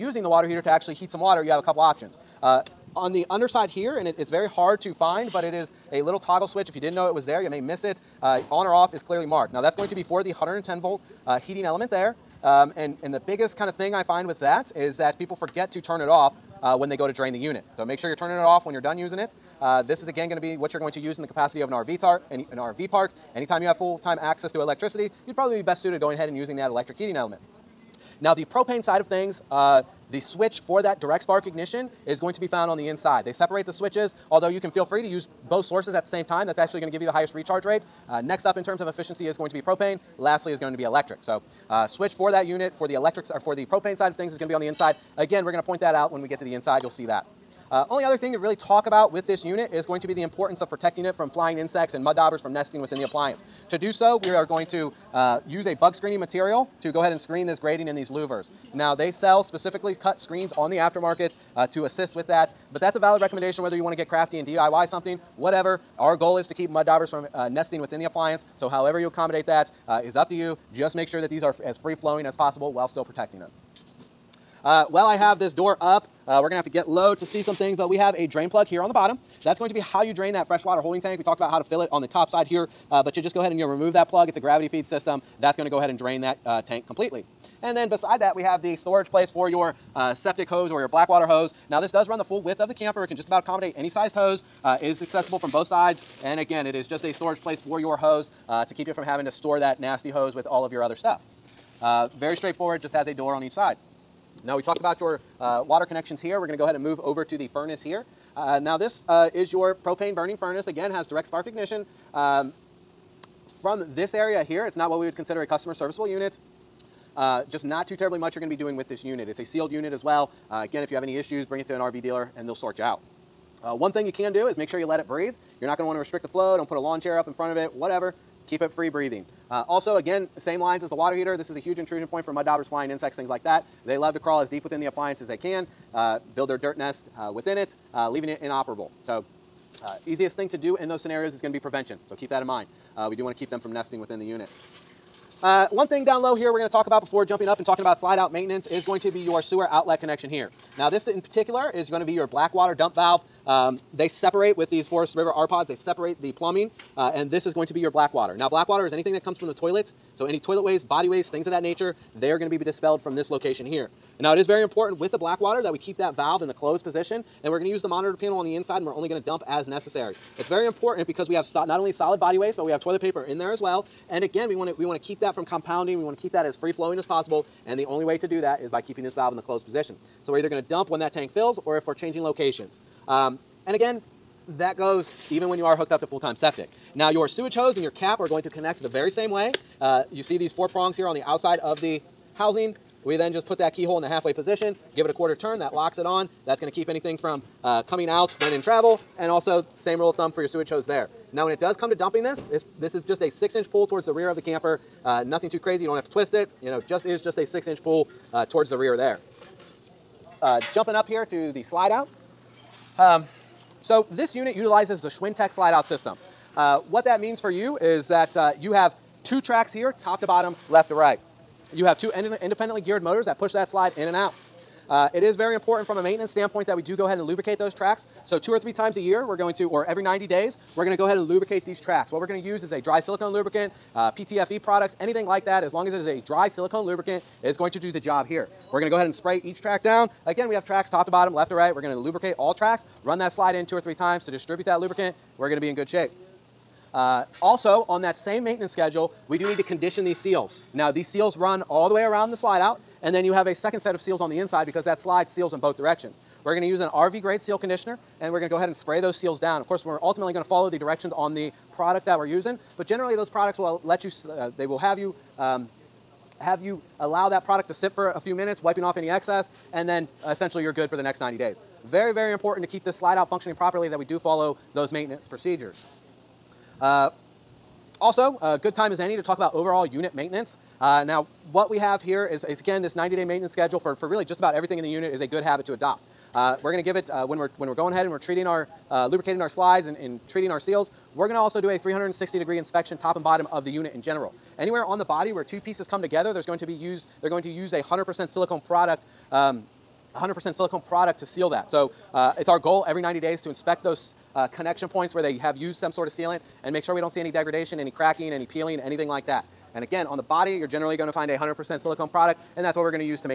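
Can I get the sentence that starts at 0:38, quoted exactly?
Uh, next up in terms of efficiency is going to be propane.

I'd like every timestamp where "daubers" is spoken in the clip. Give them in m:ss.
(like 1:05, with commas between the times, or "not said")
0:52, 1:06, 2:12.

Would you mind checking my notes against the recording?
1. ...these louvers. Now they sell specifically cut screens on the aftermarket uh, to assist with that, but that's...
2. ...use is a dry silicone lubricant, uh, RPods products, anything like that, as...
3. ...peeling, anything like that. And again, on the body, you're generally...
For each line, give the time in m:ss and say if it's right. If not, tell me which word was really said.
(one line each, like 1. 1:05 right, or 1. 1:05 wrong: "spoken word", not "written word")
1. 0:57 right
2. 3:52 wrong: "PTFE", not "RPods"
3. 5:08 right.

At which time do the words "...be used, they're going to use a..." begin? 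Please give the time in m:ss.
4:56.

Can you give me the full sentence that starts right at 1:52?
Um, from this area here, it's not what we would consider a customer serviceable unit.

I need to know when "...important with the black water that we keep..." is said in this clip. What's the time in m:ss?
2:44.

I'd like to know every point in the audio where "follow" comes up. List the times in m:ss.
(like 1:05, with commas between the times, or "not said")
4:20, 4:34.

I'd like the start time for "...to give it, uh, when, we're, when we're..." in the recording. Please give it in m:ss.
4:46.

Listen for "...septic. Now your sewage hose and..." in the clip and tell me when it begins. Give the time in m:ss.
3:06.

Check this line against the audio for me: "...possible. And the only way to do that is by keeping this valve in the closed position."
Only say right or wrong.
right.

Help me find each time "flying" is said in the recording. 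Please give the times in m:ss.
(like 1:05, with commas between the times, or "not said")
0:51, 2:12.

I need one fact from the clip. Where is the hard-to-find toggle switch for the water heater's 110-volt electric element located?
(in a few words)
On the underside.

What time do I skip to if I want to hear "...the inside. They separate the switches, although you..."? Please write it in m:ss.
0:32.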